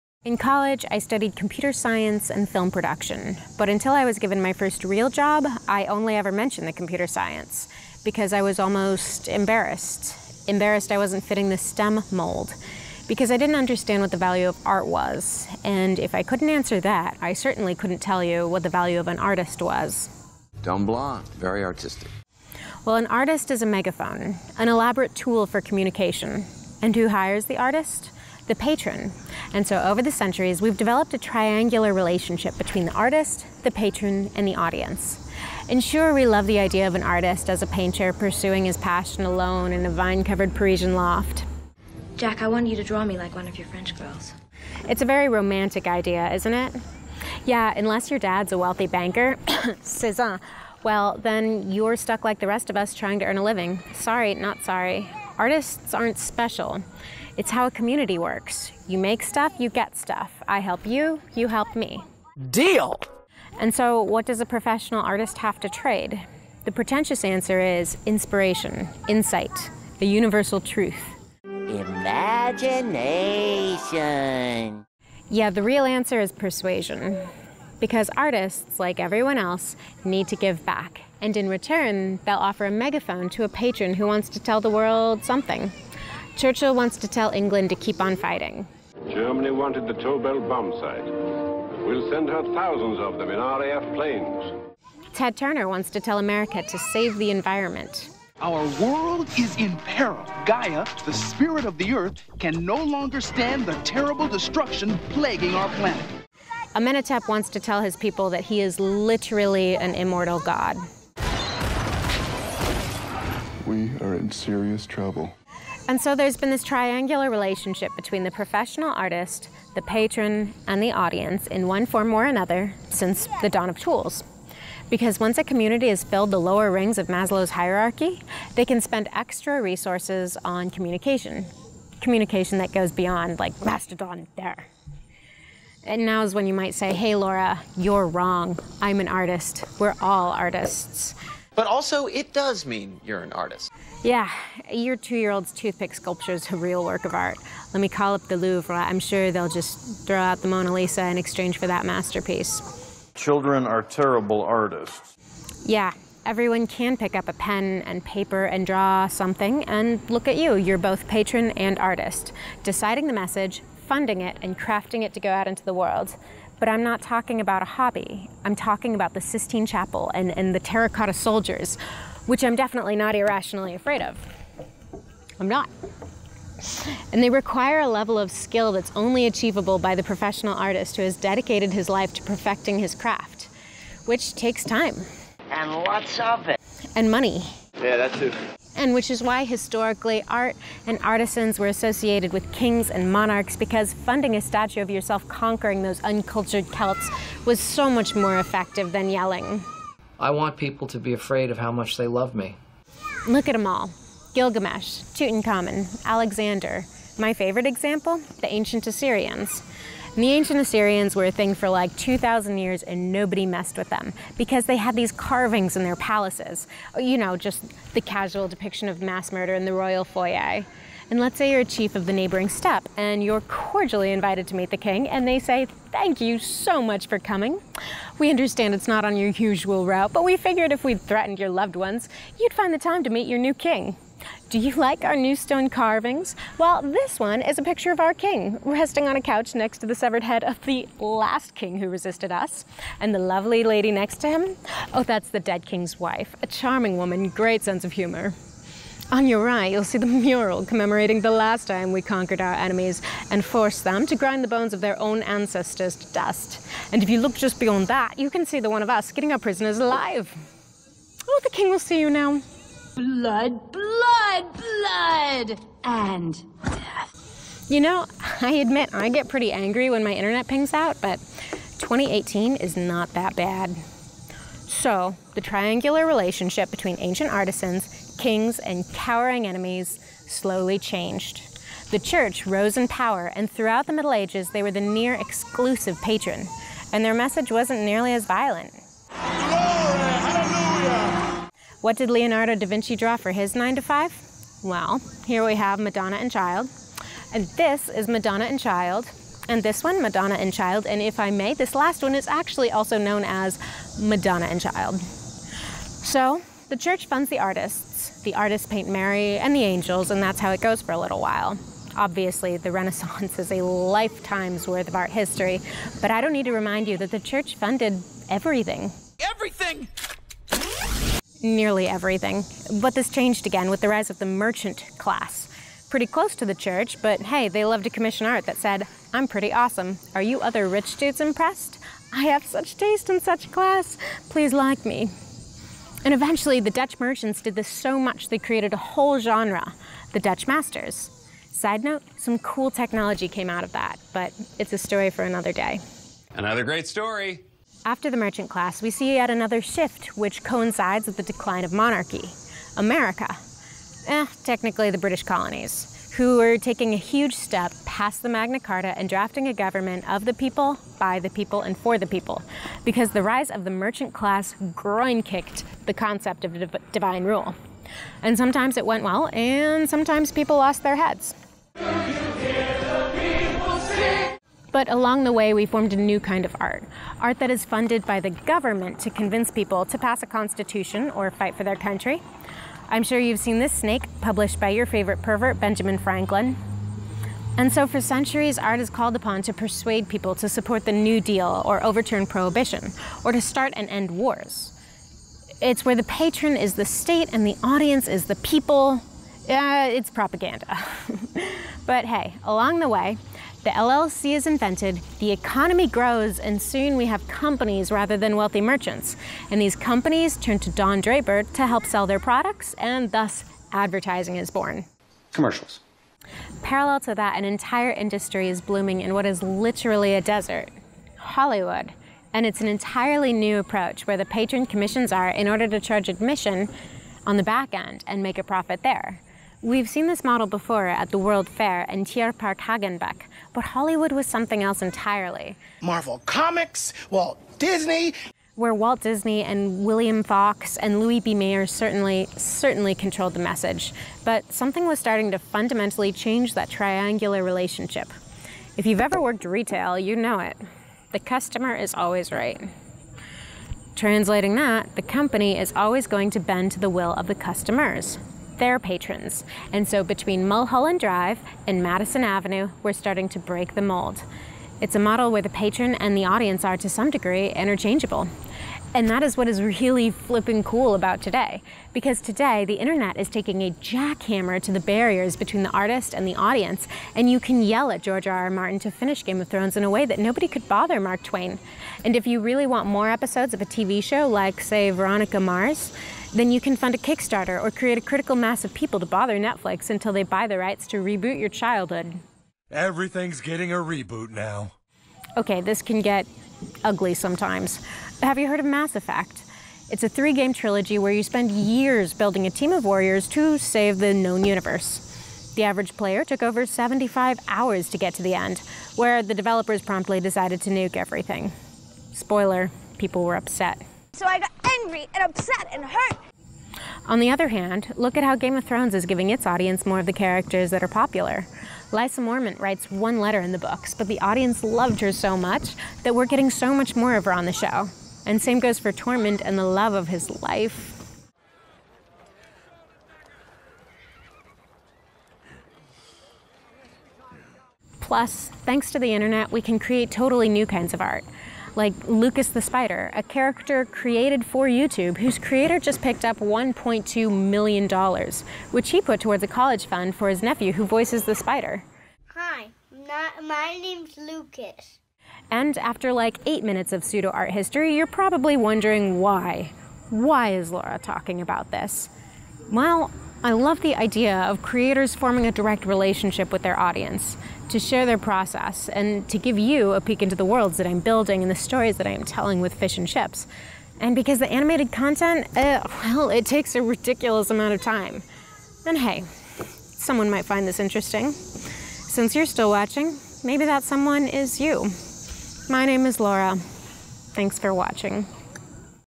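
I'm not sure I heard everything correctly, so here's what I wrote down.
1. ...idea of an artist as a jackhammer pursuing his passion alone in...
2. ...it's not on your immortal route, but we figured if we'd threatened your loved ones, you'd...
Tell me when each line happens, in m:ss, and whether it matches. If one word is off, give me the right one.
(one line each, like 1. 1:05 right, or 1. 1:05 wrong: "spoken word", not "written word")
1. 0:36 wrong: "painter", not "jackhammer"
2. 3:48 wrong: "usual", not "immortal".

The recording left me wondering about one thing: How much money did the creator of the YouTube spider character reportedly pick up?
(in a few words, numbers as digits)
$1.2 million.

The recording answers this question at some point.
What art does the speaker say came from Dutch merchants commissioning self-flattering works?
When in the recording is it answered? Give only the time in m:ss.
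5:40.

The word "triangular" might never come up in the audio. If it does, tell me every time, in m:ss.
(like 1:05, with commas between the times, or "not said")
0:31, 1:56, 4:35, 7:26.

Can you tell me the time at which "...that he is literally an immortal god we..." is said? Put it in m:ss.
1:48.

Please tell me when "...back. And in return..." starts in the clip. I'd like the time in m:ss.
1:20.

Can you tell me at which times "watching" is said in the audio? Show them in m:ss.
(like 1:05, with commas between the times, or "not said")
9:42, 9:47.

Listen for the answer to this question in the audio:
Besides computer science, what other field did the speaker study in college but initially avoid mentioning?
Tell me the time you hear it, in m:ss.
0:02.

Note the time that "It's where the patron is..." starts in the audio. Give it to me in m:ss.
6:35.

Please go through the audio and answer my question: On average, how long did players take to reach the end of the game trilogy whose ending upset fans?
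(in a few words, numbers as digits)
Over 75 hours.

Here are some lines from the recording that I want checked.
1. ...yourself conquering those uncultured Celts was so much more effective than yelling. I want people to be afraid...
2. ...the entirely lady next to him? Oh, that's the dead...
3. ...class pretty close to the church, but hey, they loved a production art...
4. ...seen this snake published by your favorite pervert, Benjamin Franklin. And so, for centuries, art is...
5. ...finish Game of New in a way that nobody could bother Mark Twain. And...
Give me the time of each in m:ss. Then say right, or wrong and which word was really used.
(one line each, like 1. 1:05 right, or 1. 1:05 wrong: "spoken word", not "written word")
1. 3:14 right
2. 4:03 wrong: "lovely", not "entirely"
3. 5:24 wrong: "commission", not "production"
4. 6:23 right
5. 7:58 wrong: "Thrones", not "New".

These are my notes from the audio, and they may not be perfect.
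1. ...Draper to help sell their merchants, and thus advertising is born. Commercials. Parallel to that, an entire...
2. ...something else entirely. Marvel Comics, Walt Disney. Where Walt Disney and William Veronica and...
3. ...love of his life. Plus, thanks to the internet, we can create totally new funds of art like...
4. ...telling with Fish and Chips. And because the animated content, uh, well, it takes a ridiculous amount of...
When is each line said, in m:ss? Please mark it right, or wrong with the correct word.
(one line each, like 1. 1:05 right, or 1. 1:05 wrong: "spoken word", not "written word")
1. 6:50 wrong: "products", not "merchants"
2. 7:14 wrong: "Fox", not "Veronica"
3. 8:49 wrong: "kinds", not "funds"
4. 9:32 right.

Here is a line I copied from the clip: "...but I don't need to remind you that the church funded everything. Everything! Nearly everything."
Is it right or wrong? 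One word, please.
right.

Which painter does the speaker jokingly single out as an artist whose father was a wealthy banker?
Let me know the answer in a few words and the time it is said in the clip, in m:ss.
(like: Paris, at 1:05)
Cezanne, at 0:49.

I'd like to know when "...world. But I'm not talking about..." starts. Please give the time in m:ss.
2:45.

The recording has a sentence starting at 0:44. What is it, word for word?
It's a very romantic idea, isn't it?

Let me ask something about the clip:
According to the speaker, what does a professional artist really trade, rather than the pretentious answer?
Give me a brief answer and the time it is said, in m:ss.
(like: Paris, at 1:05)
Persuasion, at 1:16.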